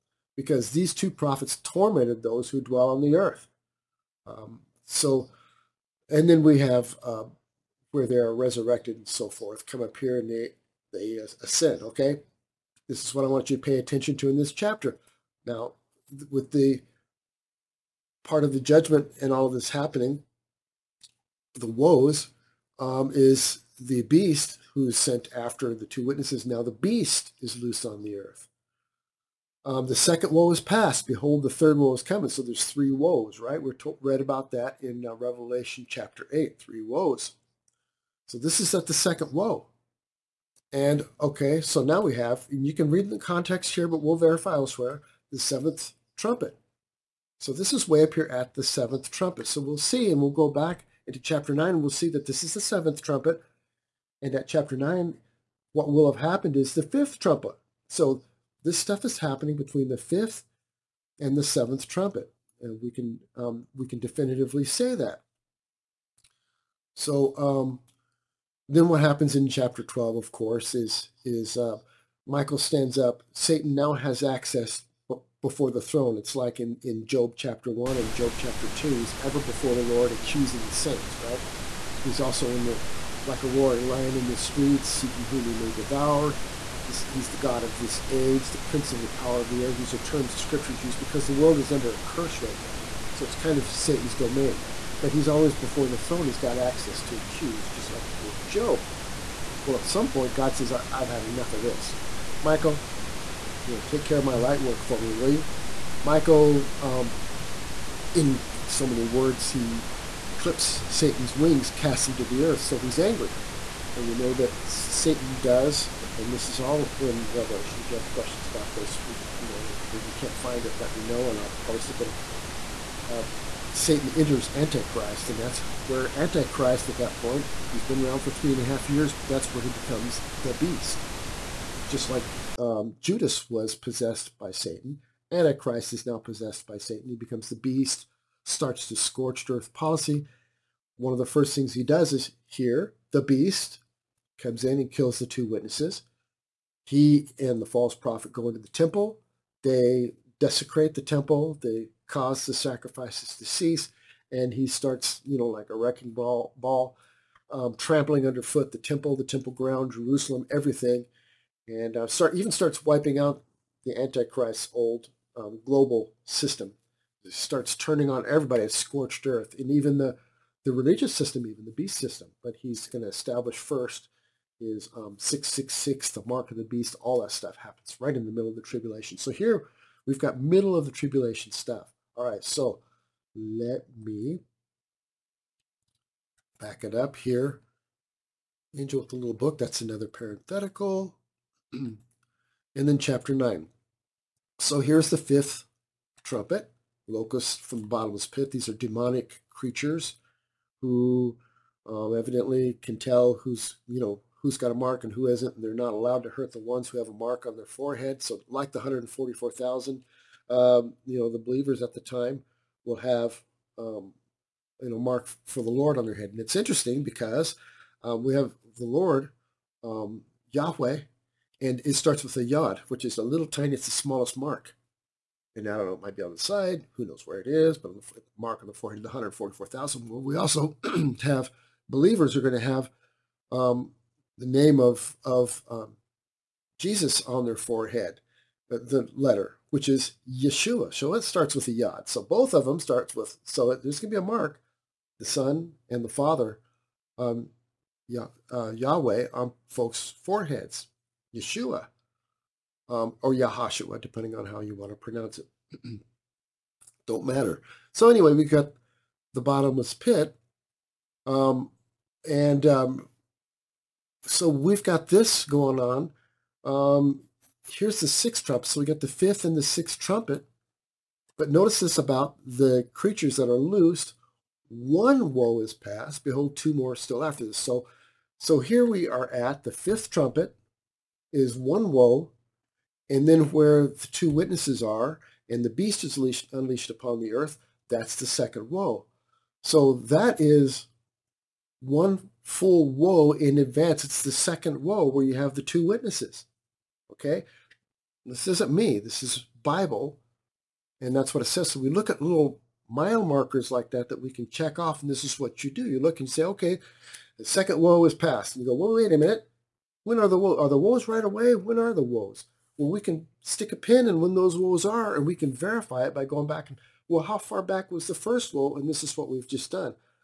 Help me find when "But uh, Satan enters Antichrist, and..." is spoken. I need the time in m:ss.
2:01.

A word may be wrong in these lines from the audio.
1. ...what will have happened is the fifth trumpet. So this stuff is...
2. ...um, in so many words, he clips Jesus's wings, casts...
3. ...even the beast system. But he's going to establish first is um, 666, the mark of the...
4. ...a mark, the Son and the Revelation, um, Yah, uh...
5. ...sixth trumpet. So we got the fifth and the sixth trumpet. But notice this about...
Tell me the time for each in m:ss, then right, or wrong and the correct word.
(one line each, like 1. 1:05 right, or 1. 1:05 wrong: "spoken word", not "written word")
1. 0:55 right
2. 1:46 wrong: "Satan", not "Jesus"
3. 2:51 right
4. 4:04 wrong: "Father", not "Revelation"
5. 4:28 right.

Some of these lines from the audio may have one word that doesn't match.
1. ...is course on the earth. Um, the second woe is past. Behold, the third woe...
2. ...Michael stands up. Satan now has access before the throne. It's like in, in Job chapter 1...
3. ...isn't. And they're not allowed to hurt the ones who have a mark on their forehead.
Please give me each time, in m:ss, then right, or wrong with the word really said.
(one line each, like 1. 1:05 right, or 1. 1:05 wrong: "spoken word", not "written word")
1. 0:27 wrong: "loose", not "course"
2. 1:12 right
3. 3:25 right.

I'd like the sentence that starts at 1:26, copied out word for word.
He's the God of this age, the prince of the power of the air.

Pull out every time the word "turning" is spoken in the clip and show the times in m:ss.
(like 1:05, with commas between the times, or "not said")
2:47.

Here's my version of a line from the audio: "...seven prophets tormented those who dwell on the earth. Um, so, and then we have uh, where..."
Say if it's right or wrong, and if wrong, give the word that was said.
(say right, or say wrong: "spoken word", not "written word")
wrong: "two", not "seven".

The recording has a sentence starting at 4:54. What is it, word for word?
It's the second woe where you have the two witnesses.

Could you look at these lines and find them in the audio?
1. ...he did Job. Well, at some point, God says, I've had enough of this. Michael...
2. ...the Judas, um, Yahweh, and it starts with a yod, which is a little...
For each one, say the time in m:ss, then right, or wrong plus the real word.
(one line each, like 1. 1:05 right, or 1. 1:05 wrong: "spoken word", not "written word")
1. 1:38 right
2. 3:38 wrong: "Lord", not "Judas".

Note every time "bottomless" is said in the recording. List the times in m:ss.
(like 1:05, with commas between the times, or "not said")
3:17, 4:19.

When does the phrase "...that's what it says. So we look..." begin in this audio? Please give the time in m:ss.
5:01.